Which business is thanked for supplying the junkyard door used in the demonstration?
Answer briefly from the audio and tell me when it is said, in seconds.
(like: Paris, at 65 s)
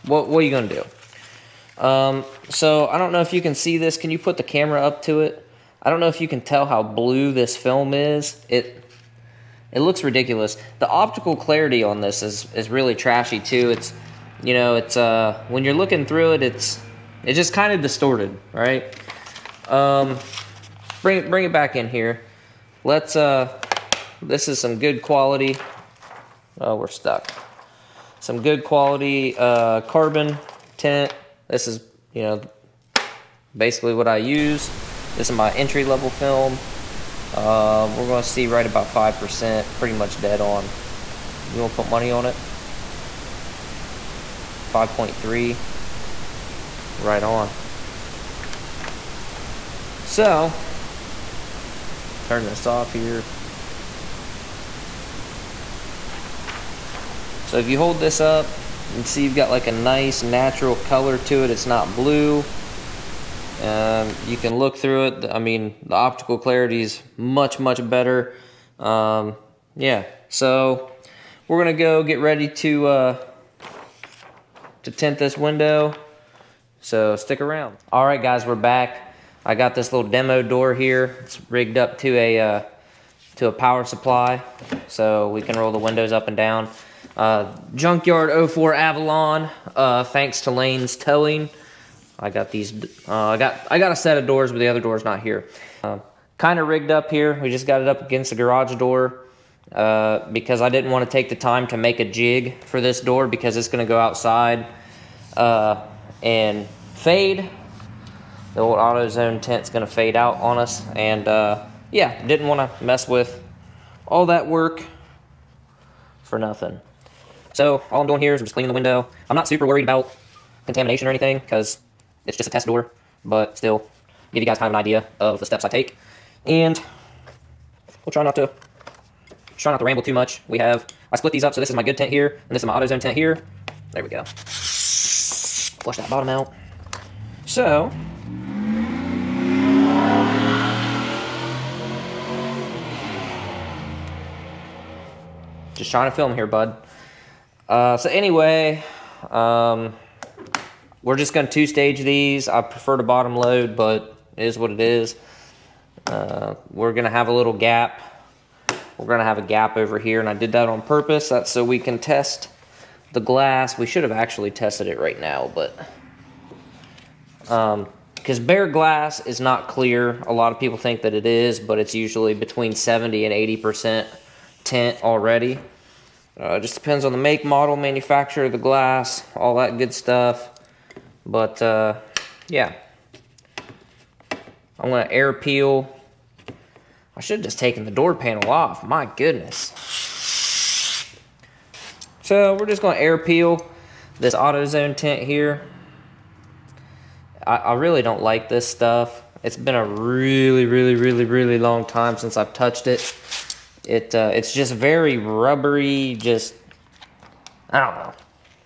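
Lane's Towing, at 90 s.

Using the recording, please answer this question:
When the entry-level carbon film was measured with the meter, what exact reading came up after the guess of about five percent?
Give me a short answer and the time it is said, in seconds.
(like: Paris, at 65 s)
5.3, at 44 s.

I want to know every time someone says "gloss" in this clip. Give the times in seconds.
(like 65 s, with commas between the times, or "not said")
not said.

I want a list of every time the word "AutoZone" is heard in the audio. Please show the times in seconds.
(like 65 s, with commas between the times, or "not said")
108 s, 132 s, 194 s.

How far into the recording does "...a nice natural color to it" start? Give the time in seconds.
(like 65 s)
59 s.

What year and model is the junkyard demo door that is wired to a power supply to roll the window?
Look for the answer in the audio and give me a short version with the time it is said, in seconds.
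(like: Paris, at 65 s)
04 Avalon, at 88 s.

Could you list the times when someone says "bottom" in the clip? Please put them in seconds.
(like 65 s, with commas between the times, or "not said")
136 s, 153 s.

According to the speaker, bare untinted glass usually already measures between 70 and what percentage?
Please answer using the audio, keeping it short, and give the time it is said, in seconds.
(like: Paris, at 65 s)
80%, at 173 s.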